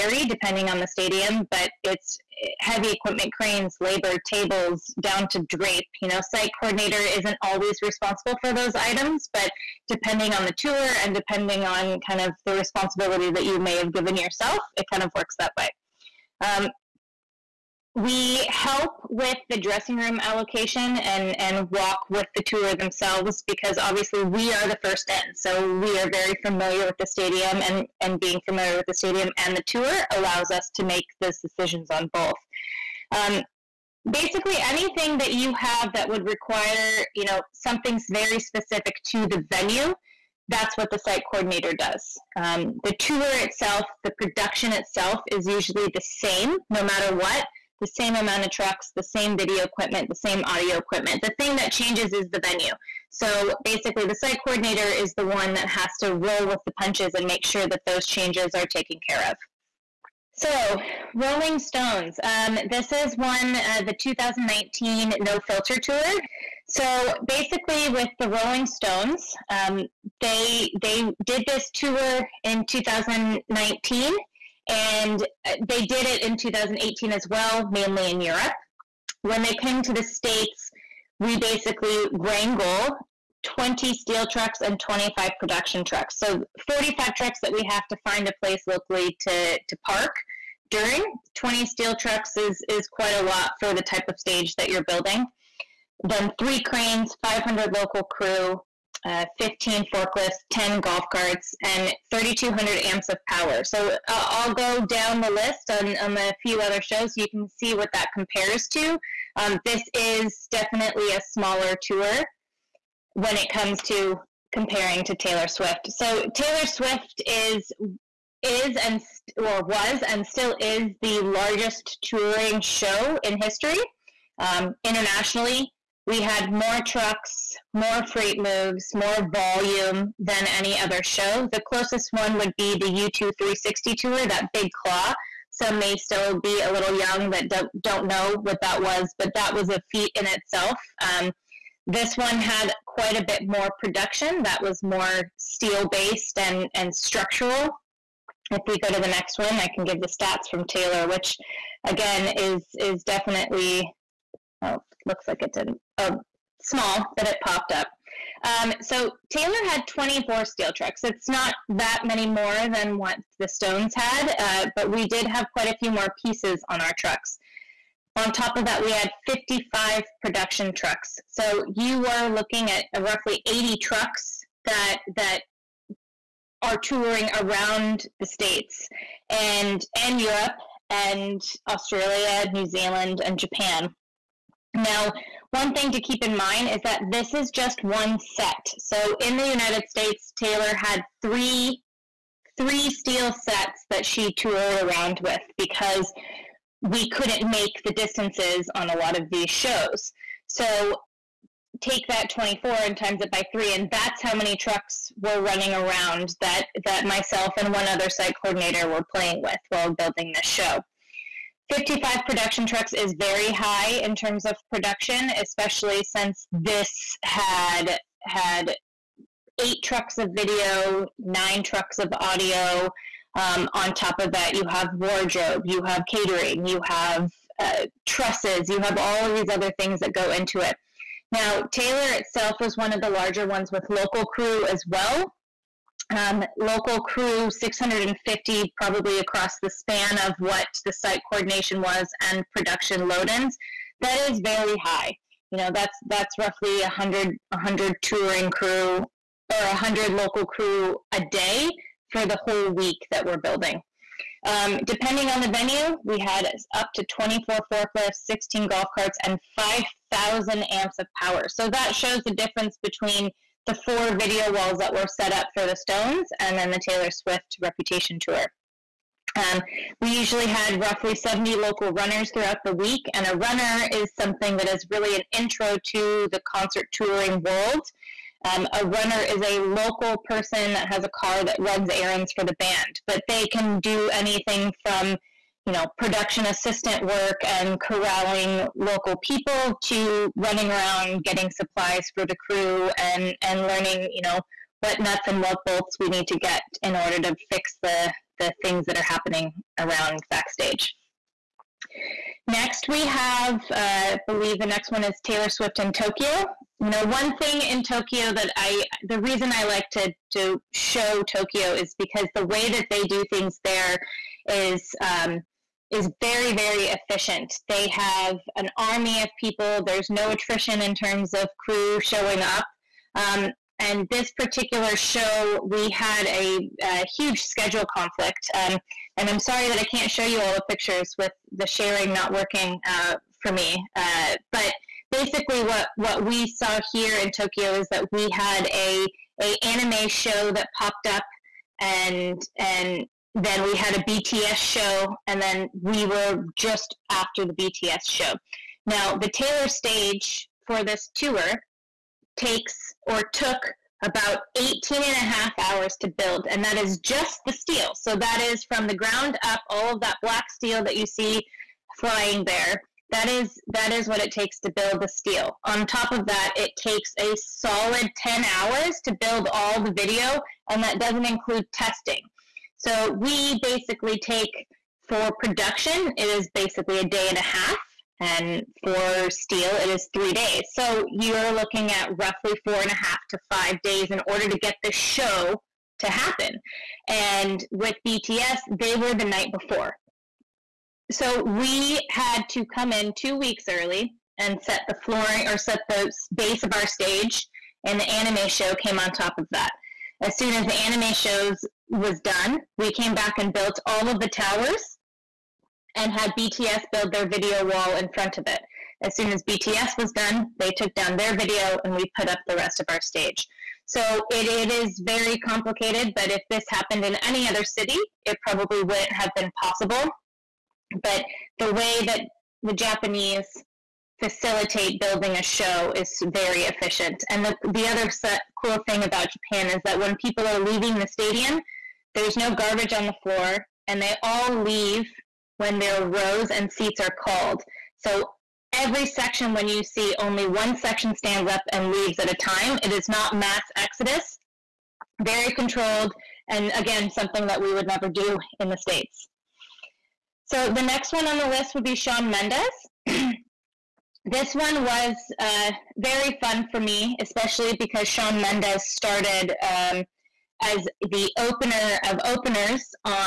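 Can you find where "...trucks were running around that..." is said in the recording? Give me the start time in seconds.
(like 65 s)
204 s.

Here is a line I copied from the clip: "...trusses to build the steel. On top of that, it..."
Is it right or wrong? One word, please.
wrong.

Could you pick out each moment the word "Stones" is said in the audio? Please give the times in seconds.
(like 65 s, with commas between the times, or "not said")
61 s, 68 s, 163 s, 265 s.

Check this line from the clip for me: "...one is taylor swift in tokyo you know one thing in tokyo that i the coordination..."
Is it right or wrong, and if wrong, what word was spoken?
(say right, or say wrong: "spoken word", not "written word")
wrong: "reason", not "coordination".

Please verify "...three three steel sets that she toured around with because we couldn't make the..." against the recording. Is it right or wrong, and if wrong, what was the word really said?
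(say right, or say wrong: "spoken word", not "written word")
right.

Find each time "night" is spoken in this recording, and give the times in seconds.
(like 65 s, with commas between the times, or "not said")
389 s.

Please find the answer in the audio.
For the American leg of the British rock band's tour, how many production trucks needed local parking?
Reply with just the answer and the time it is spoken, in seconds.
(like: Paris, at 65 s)
25, at 84 s.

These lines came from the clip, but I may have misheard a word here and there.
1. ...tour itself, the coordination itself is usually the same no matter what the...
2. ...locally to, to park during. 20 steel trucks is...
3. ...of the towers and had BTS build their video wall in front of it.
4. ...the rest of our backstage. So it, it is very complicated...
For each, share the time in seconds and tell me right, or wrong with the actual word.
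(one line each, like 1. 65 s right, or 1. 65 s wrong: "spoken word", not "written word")
1. 42 s wrong: "production", not "coordination"
2. 88 s right
3. 404 s right
4. 412 s wrong: "stage", not "backstage".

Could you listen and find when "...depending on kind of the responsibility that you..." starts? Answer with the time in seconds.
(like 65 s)
11 s.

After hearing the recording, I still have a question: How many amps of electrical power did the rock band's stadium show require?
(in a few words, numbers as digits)
3,200 amps.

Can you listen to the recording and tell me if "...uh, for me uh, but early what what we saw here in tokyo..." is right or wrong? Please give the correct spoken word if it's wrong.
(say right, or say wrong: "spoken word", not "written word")
wrong: "basically", not "early".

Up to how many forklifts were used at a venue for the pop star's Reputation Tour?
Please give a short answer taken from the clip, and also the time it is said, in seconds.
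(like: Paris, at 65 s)
24, at 257 s.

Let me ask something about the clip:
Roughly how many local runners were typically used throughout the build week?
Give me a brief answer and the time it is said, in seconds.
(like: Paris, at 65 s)
70, at 271 s.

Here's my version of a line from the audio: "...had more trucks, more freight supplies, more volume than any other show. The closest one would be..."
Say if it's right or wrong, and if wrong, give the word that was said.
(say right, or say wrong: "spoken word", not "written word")
wrong: "moves", not "supplies".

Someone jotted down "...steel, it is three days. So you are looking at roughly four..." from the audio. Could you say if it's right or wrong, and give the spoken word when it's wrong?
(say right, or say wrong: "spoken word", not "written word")
right.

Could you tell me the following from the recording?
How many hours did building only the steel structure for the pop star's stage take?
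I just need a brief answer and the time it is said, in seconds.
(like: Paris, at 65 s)
18 and a half, at 354 s.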